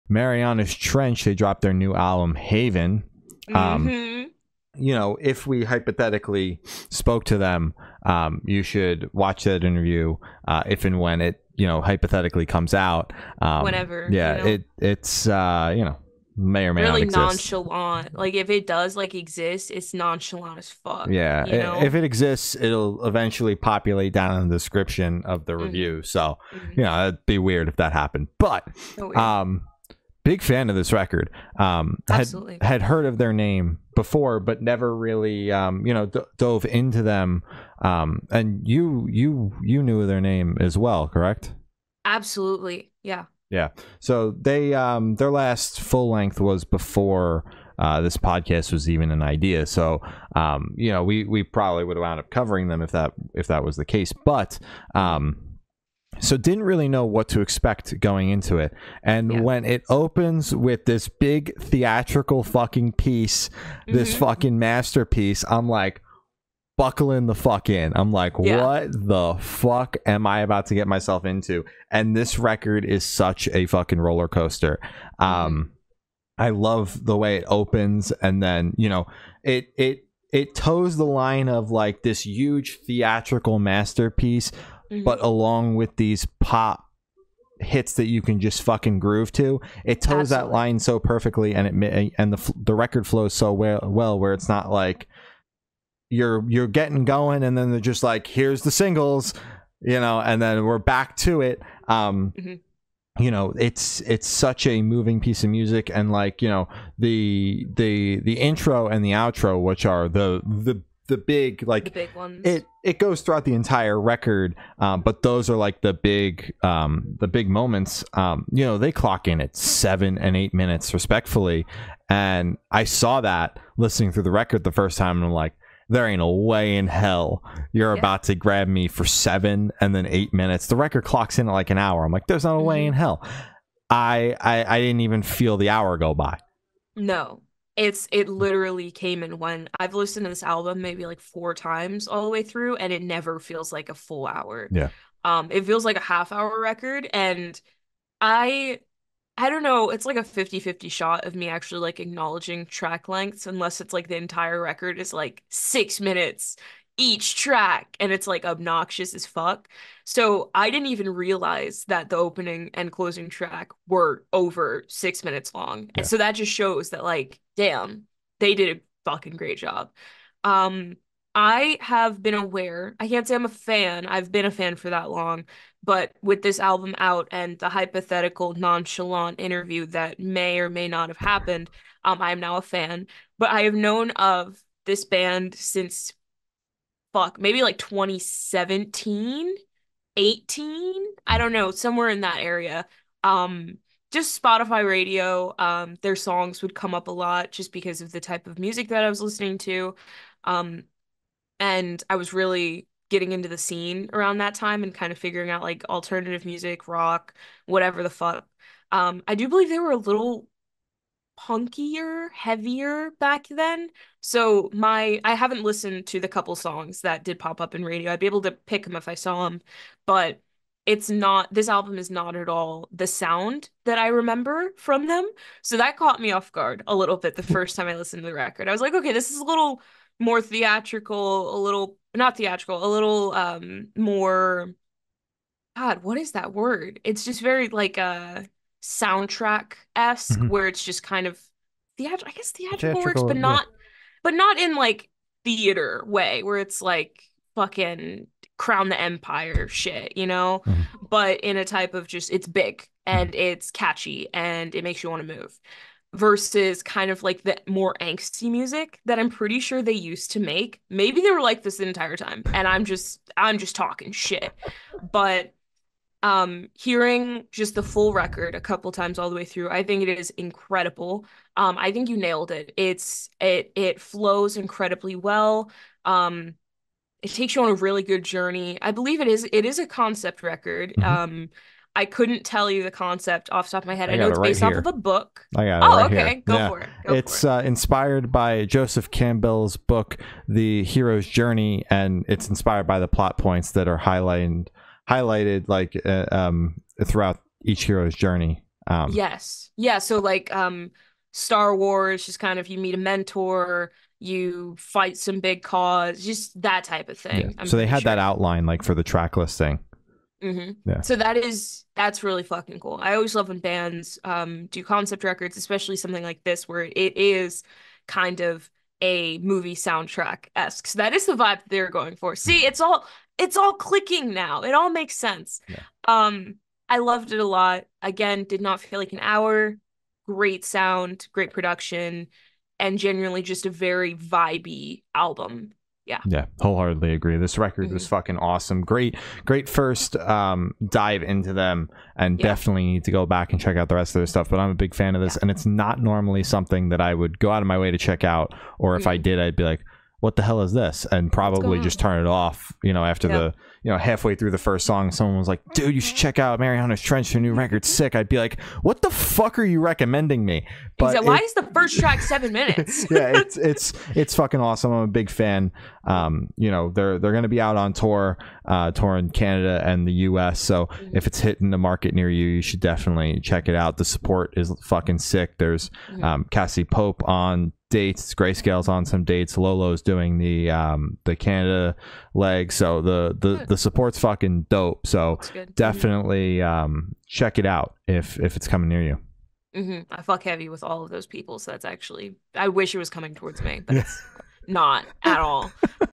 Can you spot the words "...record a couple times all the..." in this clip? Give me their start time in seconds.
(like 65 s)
268 s.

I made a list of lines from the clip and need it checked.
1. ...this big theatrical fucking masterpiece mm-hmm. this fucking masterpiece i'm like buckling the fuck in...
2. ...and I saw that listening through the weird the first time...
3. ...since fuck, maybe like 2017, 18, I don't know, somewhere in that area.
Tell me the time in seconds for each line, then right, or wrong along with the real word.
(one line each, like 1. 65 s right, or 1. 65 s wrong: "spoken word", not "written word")
1. 60 s wrong: "piece", not "masterpiece"
2. 122 s wrong: "record", not "weird"
3. 185 s right.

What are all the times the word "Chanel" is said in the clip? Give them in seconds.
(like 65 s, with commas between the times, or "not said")
not said.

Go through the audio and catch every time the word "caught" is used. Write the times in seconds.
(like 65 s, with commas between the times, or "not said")
225 s.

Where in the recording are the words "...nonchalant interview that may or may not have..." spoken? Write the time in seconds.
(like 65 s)
178 s.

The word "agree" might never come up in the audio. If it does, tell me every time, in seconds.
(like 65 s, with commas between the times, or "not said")
337 s.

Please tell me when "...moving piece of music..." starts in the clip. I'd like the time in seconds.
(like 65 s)
104 s.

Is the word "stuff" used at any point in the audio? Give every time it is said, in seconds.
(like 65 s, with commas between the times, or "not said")
344 s.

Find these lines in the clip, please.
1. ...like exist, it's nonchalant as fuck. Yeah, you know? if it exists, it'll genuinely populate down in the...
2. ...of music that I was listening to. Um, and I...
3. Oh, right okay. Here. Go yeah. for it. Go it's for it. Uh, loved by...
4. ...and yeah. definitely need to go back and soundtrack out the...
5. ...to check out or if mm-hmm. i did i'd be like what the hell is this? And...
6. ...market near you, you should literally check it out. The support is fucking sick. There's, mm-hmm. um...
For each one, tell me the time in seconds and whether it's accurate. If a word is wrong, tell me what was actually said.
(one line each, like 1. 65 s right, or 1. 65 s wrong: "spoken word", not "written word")
1. 18 s wrong: "eventually", not "genuinely"
2. 198 s right
3. 285 s wrong: "inspired", not "loved"
4. 342 s wrong: "check", not "soundtrack"
5. 347 s right
6. 371 s wrong: "definitely", not "literally".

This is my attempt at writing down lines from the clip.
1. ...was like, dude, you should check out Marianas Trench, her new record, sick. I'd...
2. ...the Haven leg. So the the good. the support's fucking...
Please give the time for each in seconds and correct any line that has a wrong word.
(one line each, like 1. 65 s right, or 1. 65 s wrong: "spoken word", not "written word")
1. 355 s right
2. 381 s wrong: "Canada", not "Haven".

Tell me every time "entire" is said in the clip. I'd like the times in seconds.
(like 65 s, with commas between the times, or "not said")
113 s, 154 s, 261 s.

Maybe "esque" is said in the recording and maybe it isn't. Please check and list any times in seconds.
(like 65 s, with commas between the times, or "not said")
239 s, 320 s.